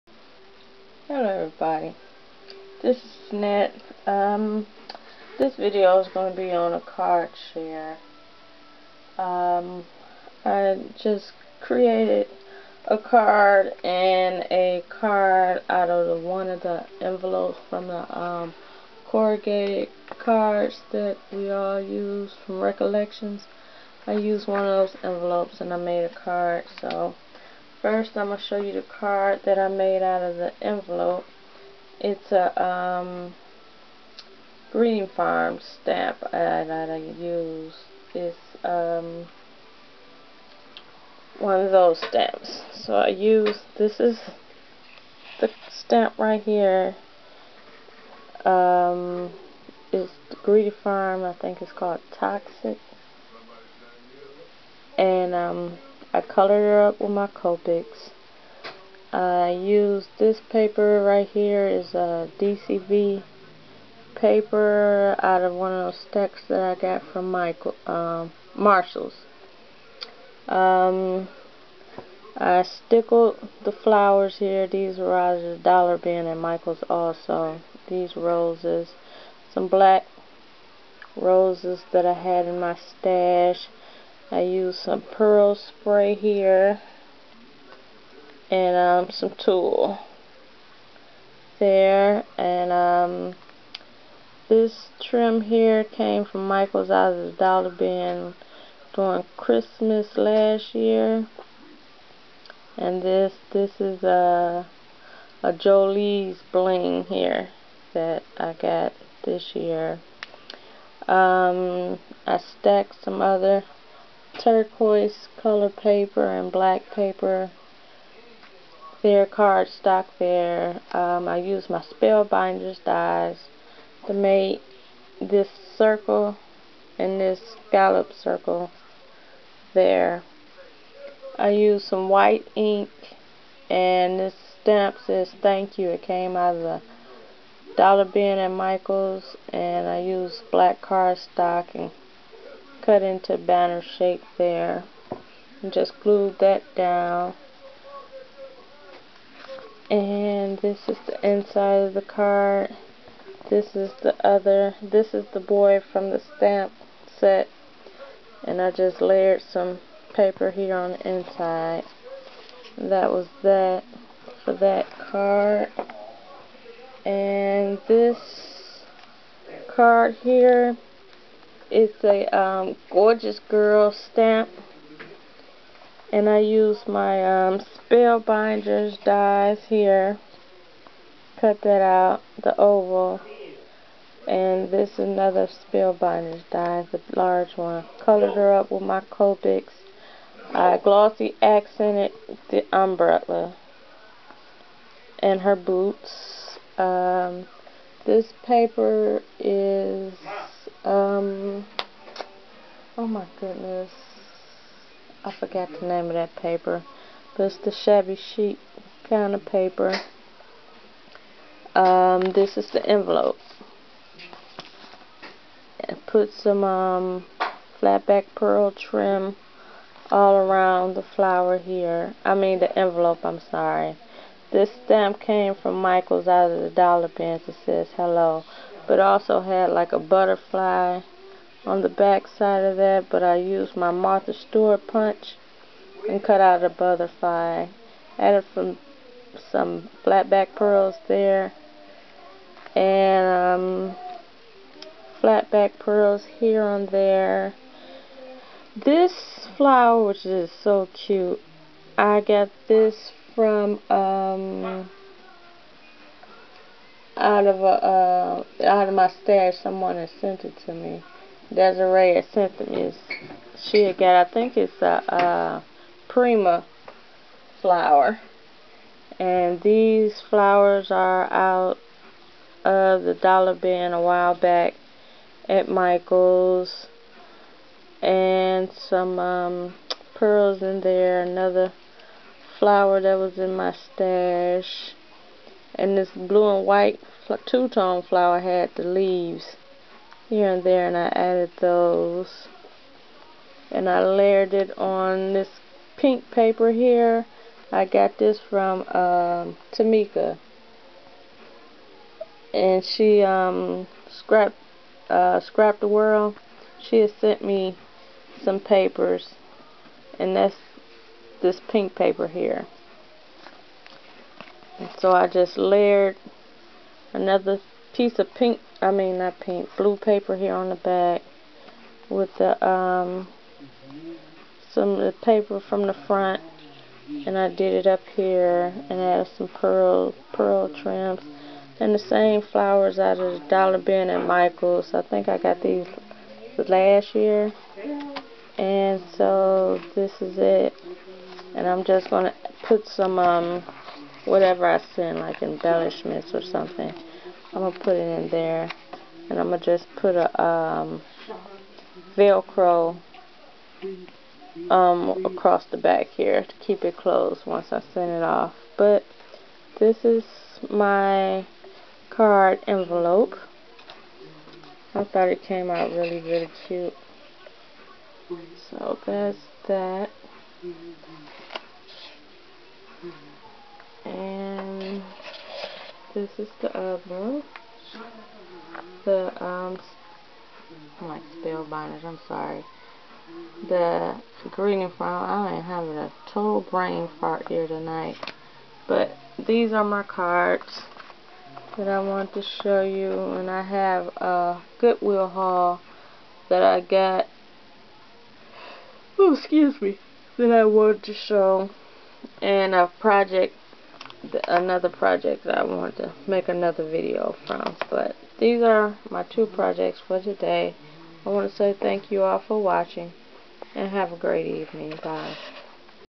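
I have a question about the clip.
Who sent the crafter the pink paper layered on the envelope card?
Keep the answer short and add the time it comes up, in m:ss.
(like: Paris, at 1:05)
Tamika, at 4:59.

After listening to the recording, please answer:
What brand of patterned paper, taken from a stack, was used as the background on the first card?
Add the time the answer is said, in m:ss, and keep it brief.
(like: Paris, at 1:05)
DCV, at 1:02.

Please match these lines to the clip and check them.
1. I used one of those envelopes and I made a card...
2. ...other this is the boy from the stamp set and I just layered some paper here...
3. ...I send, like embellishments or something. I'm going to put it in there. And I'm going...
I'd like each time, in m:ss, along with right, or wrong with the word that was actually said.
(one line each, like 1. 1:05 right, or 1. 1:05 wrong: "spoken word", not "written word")
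1. 0:24 right
2. 2:34 right
3. 5:44 right.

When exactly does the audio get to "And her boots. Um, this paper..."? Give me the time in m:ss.
3:15.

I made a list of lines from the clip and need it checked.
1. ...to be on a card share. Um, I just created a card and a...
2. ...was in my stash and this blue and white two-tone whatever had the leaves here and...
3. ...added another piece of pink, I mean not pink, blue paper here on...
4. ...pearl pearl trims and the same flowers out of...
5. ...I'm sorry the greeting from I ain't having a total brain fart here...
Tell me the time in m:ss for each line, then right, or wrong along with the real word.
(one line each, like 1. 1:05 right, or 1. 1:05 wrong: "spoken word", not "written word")
1. 0:06 right
2. 4:43 wrong: "flower", not "whatever"
3. 5:15 wrong: "layered", not "added"
4. 5:29 right
5. 6:22 right.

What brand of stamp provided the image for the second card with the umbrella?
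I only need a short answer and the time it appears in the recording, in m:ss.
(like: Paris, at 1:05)
Gorgeous Girl, at 2:52.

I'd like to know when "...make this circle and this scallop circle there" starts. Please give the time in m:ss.
2:04.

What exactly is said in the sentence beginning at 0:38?
It's um, one of those stamps.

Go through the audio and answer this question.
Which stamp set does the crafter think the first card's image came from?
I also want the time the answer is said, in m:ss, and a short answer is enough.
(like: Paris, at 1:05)
Toxic, at 0:52.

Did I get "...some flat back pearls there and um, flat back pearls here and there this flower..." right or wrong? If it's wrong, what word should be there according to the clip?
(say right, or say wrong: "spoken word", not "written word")
right.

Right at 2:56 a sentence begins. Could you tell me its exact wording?
And I use my um, Spellbinders dies here.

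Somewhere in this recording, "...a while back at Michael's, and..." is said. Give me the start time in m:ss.
4:33.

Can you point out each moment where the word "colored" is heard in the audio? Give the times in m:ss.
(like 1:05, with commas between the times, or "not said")
0:56, 1:55, 3:08.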